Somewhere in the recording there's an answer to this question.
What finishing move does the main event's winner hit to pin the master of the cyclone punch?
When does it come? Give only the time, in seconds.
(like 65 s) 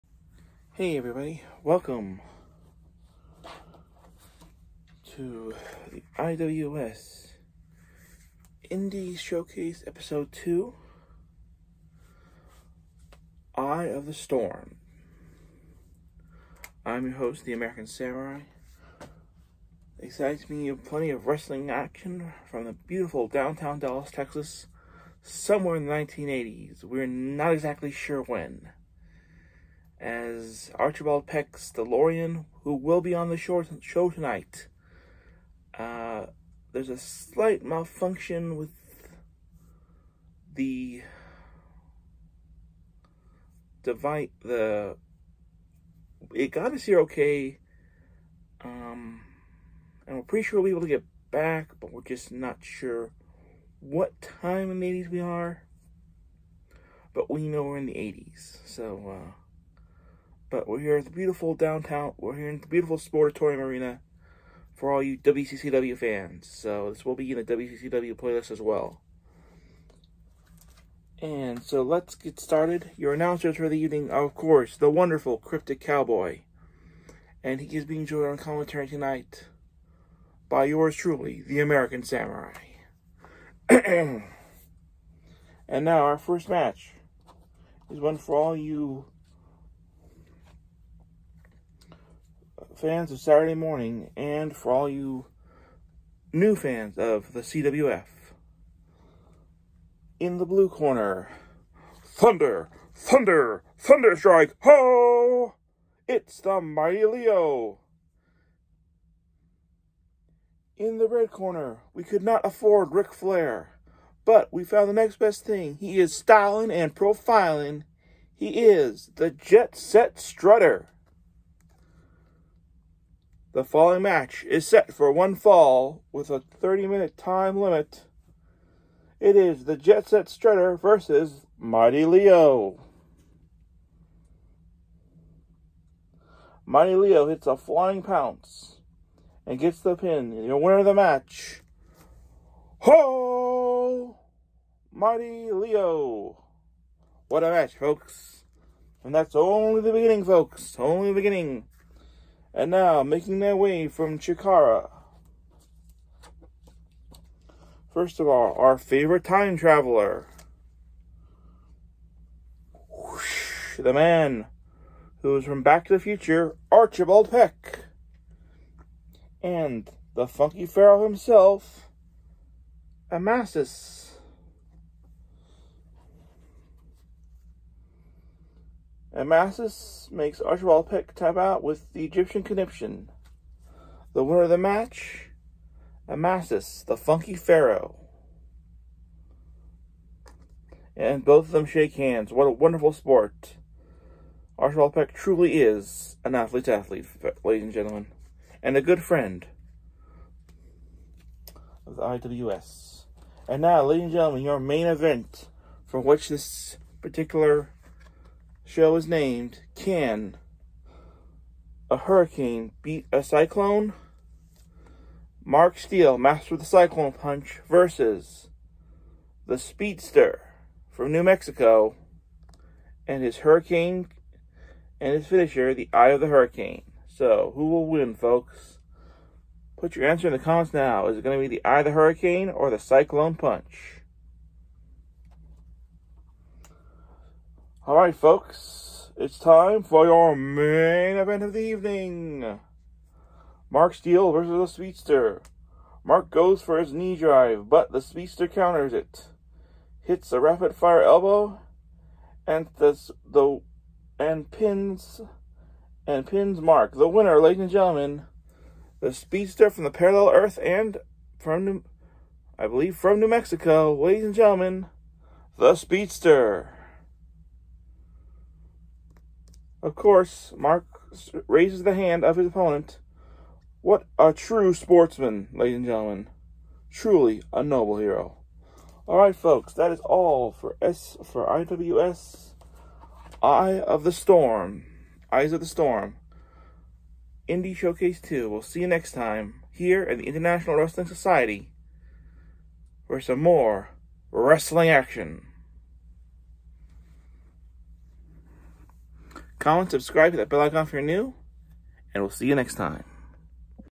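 250 s.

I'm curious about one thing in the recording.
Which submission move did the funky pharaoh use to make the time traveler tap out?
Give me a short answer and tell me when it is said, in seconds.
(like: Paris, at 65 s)
Egyptian conniption, at 182 s.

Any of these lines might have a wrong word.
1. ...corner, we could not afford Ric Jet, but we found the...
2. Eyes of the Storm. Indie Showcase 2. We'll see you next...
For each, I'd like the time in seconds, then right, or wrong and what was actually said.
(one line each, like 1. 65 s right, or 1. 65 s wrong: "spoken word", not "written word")
1. 111 s wrong: "Flair", not "Jet"
2. 285 s right.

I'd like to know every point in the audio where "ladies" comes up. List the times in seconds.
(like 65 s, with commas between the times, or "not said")
197 s, 203 s, 257 s, 263 s, 275 s.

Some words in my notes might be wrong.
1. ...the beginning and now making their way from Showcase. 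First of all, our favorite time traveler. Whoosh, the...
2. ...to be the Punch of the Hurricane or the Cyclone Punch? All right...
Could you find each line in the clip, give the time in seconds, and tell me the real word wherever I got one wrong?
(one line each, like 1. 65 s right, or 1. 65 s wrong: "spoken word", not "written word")
1. 151 s wrong: "Chikara", not "Showcase"
2. 231 s wrong: "Eye", not "Punch".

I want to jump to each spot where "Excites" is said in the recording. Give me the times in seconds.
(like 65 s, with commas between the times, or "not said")
19 s.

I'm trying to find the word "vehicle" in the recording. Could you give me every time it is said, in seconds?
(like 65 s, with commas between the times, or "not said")
not said.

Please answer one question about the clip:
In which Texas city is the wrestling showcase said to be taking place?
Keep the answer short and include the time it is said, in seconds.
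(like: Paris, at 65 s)
Dallas, at 23 s.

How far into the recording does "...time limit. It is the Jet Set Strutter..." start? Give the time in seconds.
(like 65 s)
127 s.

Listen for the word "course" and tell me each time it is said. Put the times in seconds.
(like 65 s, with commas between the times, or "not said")
74 s, 269 s.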